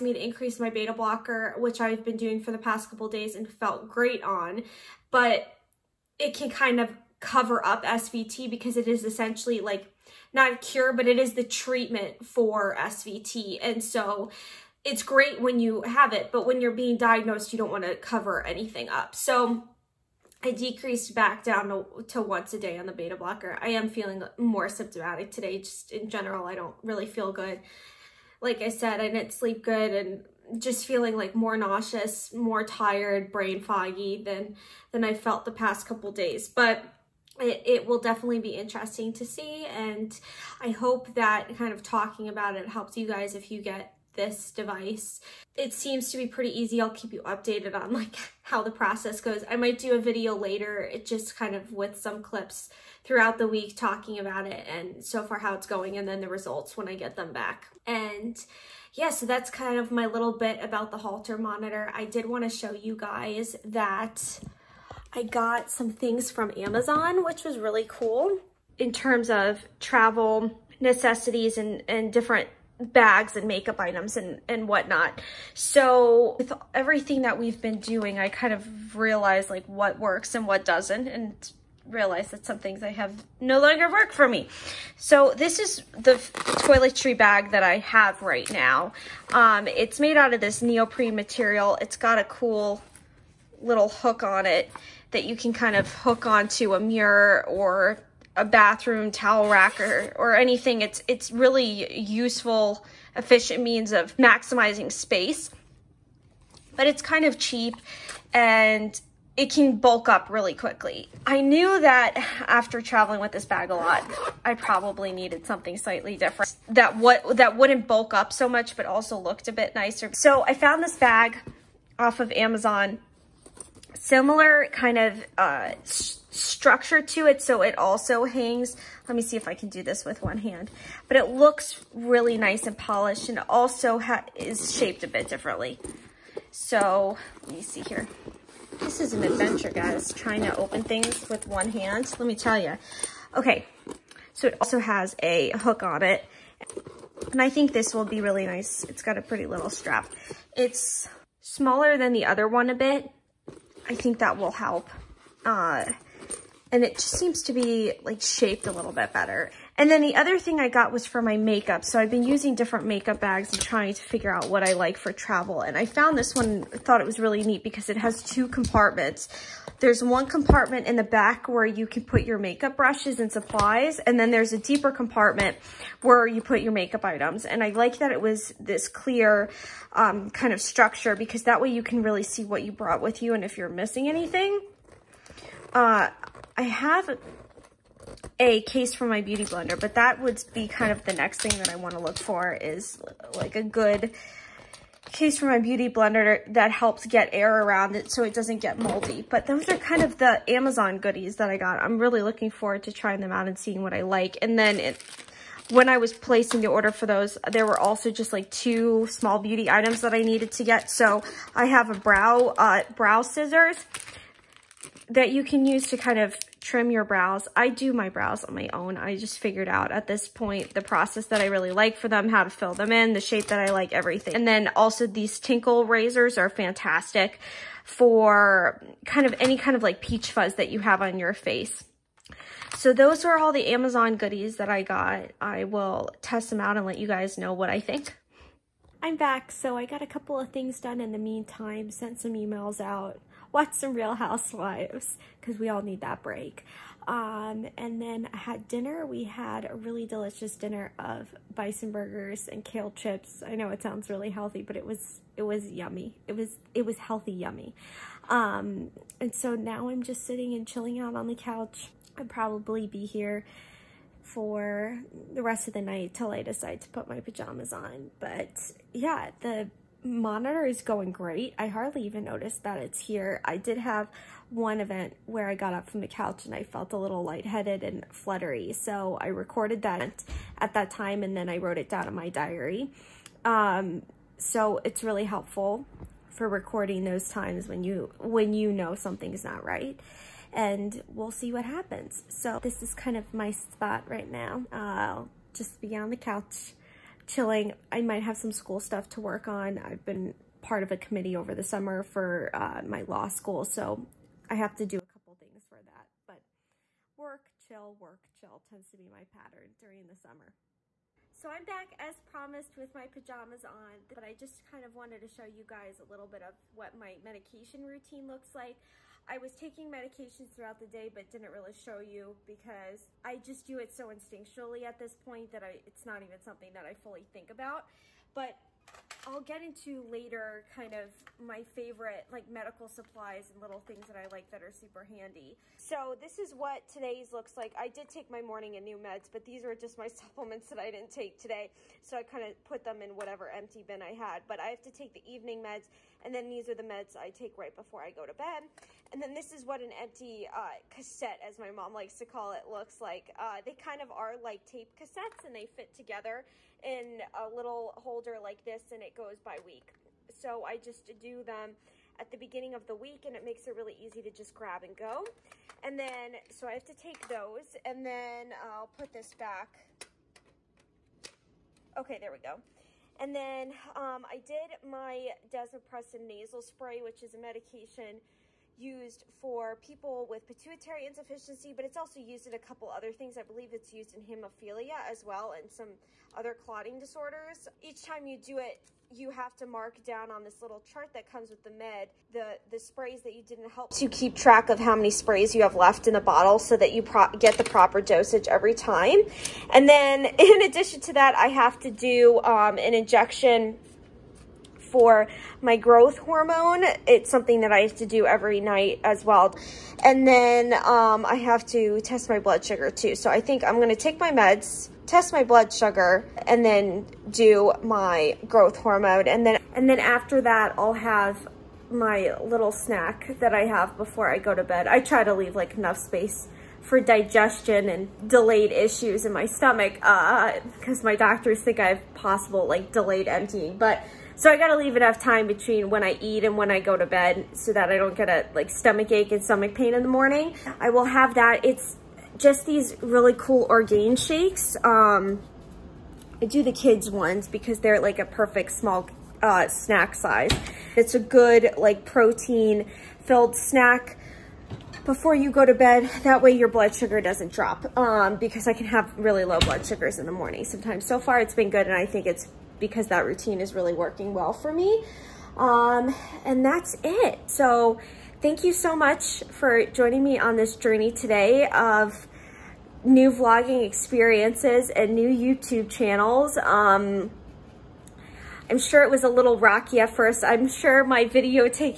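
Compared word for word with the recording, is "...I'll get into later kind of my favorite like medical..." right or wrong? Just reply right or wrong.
right.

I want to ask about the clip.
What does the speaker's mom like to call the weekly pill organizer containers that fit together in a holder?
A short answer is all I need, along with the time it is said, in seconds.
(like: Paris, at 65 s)
Cassette, at 350 s.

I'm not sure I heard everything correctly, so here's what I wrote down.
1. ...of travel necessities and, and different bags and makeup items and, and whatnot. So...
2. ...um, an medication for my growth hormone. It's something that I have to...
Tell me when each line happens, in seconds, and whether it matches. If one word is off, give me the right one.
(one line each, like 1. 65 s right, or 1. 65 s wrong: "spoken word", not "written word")
1. 69 s right
2. 402 s wrong: "injection", not "medication".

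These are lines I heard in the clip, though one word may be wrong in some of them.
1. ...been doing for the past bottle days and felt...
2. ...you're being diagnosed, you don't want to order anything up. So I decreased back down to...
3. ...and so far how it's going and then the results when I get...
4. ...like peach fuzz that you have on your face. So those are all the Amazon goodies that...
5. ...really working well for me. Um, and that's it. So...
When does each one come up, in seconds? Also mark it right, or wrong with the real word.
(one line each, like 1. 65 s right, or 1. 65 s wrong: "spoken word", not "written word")
1. 2 s wrong: "couple", not "bottle"
2. 16 s wrong: "cover", not "order"
3. 54 s right
4. 229 s right
5. 463 s right.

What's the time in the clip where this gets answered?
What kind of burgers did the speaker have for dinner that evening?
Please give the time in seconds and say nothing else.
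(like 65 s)
251 s.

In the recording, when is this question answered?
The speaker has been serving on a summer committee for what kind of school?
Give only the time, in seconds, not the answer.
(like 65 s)
303 s.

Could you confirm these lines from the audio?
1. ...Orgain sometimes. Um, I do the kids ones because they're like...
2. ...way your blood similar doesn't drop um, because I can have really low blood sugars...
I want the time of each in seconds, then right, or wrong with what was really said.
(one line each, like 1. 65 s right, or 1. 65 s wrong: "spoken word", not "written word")
1. 443 s wrong: "shakes", not "sometimes"
2. 456 s wrong: "sugar", not "similar".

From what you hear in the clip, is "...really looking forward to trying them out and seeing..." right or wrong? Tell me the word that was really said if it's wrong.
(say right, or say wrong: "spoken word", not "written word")
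right.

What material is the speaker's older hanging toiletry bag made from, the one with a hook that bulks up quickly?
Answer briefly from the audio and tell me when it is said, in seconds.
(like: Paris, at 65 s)
Neoprene, at 90 s.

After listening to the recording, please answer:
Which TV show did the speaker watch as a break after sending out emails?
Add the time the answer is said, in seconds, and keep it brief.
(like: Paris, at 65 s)
Real Housewives, at 243 s.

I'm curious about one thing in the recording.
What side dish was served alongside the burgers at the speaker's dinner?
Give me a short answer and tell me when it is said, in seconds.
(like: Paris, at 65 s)
Kale chips, at 252 s.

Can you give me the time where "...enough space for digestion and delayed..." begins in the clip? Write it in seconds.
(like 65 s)
425 s.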